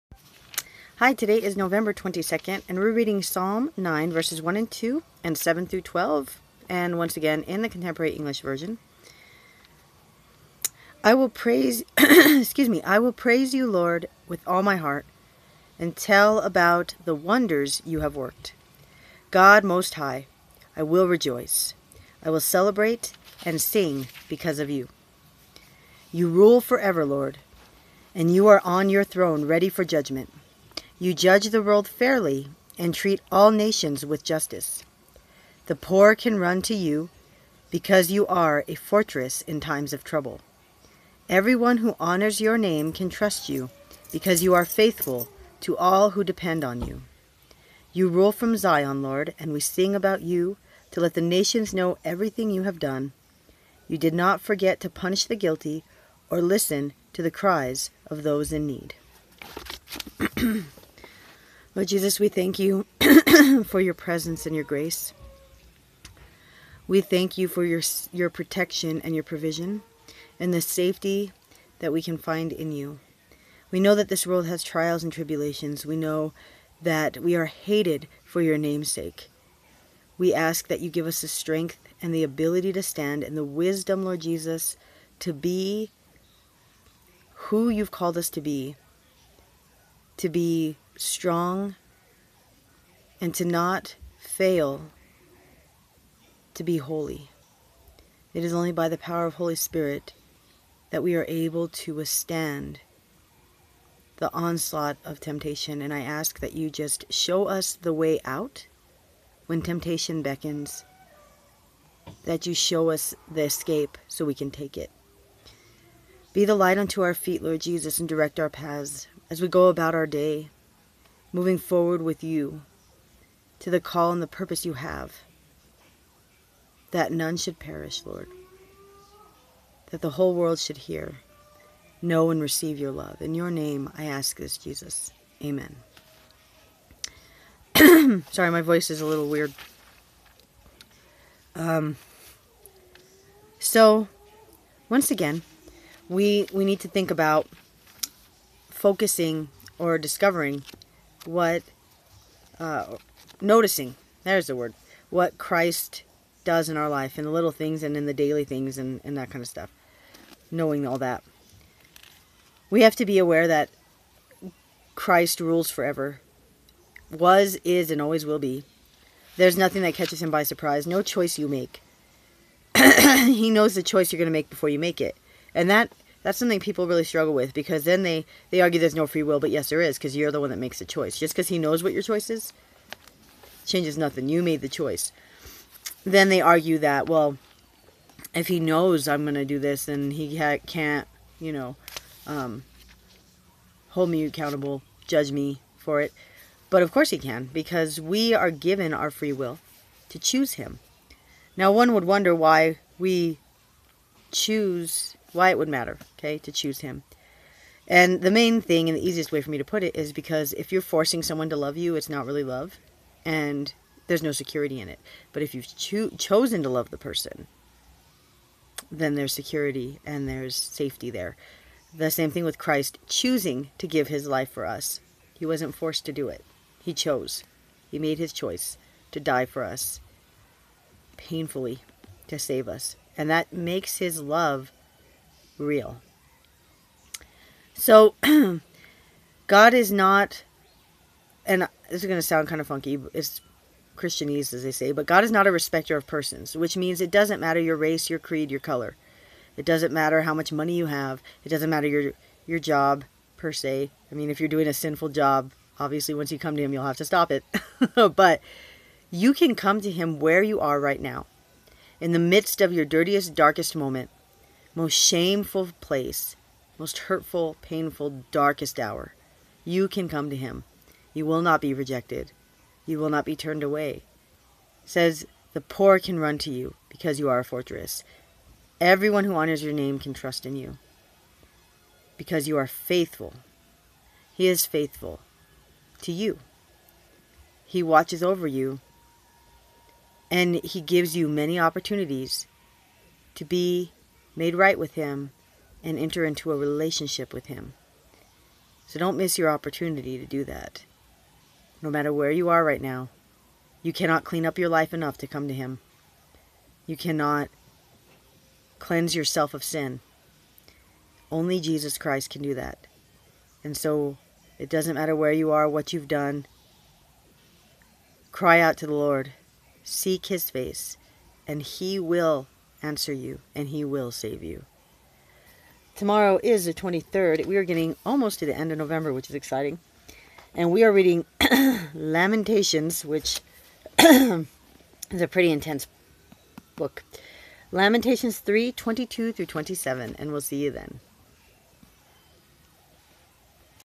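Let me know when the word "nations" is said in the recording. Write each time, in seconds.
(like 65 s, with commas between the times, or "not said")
33 s, 51 s.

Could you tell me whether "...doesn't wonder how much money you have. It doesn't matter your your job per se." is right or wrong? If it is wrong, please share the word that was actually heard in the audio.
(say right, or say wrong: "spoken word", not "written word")
wrong: "matter", not "wonder".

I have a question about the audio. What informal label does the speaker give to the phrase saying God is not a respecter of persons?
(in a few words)
Christianese.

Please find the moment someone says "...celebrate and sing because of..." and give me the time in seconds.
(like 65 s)
22 s.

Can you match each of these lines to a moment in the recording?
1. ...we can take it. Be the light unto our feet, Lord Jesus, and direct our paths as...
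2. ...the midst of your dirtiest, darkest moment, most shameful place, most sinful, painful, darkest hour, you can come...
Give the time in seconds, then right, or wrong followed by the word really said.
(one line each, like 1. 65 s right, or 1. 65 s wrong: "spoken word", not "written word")
1. 114 s right
2. 262 s wrong: "hurtful", not "sinful".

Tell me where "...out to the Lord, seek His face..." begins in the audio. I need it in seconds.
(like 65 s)
318 s.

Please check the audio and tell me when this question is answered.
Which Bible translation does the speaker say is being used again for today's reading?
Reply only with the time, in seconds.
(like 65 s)
7 s.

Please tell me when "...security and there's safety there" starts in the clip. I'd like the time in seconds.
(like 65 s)
219 s.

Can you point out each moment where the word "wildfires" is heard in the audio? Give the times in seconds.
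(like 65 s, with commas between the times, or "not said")
not said.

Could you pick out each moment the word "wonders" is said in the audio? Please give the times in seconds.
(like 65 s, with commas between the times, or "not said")
17 s, 202 s.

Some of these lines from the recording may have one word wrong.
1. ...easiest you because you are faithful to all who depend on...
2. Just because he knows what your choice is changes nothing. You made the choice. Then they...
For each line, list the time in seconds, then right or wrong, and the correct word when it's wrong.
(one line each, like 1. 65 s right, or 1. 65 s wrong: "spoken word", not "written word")
1. 43 s wrong: "trust", not "easiest"
2. 181 s right.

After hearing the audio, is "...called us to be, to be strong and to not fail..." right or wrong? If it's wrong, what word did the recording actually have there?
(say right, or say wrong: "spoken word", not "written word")
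right.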